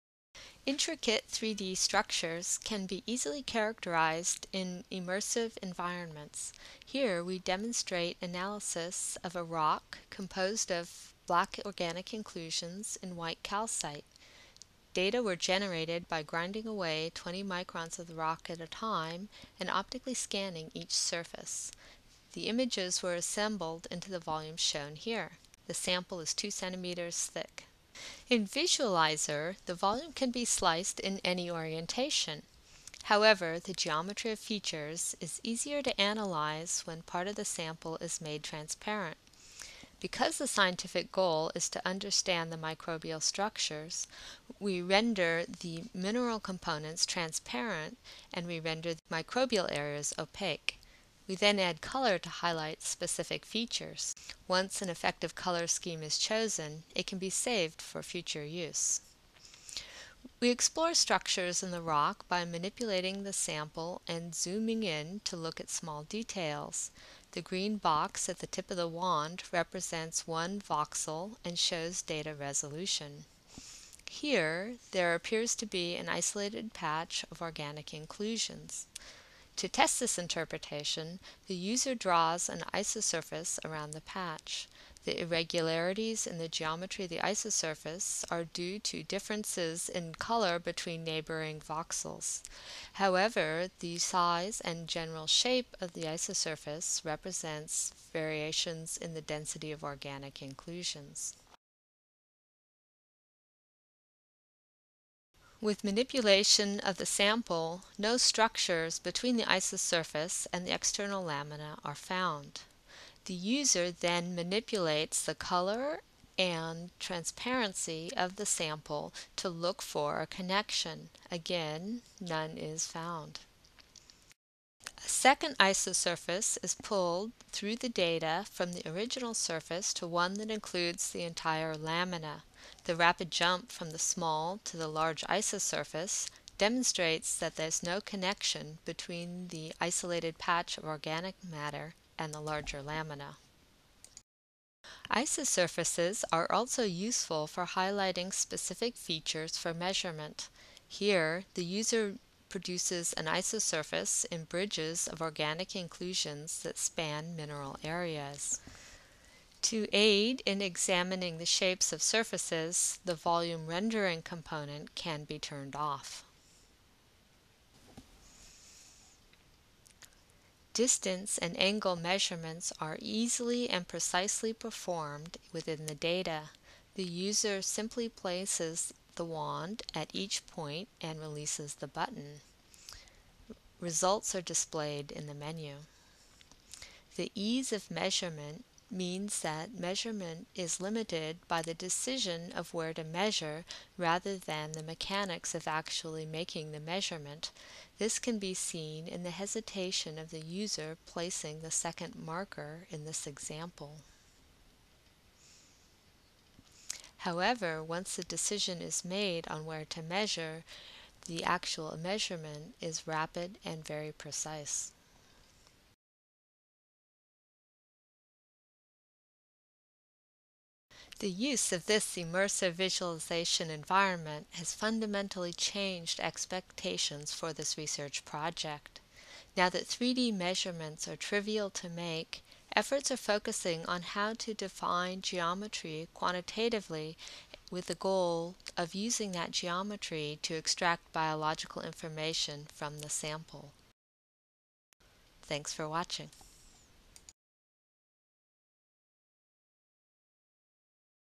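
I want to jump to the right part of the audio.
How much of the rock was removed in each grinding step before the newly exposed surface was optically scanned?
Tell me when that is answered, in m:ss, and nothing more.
0:17.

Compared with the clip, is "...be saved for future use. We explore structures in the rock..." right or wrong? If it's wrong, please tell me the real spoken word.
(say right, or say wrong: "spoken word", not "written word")
right.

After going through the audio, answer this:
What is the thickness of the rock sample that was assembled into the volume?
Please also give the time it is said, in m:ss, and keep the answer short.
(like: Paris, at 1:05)
2 centimeters, at 0:26.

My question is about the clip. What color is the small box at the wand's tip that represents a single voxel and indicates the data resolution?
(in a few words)
Green.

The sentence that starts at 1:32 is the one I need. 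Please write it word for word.
However, the size and general shape of the isosurface represents variations in the density of organic inclusions.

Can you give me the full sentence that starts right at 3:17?
This can be seen in the hesitation of the user placing the second marker in this example.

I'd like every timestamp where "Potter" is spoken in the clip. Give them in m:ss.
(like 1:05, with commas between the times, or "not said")
not said.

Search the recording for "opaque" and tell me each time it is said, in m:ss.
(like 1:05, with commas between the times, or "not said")
0:50.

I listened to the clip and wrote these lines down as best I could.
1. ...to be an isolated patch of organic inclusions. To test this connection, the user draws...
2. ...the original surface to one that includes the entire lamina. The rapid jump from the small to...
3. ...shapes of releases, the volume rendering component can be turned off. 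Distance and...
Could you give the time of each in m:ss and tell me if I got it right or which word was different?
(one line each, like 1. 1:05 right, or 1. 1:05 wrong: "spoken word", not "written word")
1. 1:15 wrong: "interpretation", not "connection"
2. 2:08 right
3. 2:41 wrong: "surfaces", not "releases".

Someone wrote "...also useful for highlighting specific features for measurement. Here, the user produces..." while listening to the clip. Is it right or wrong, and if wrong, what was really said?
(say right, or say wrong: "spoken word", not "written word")
right.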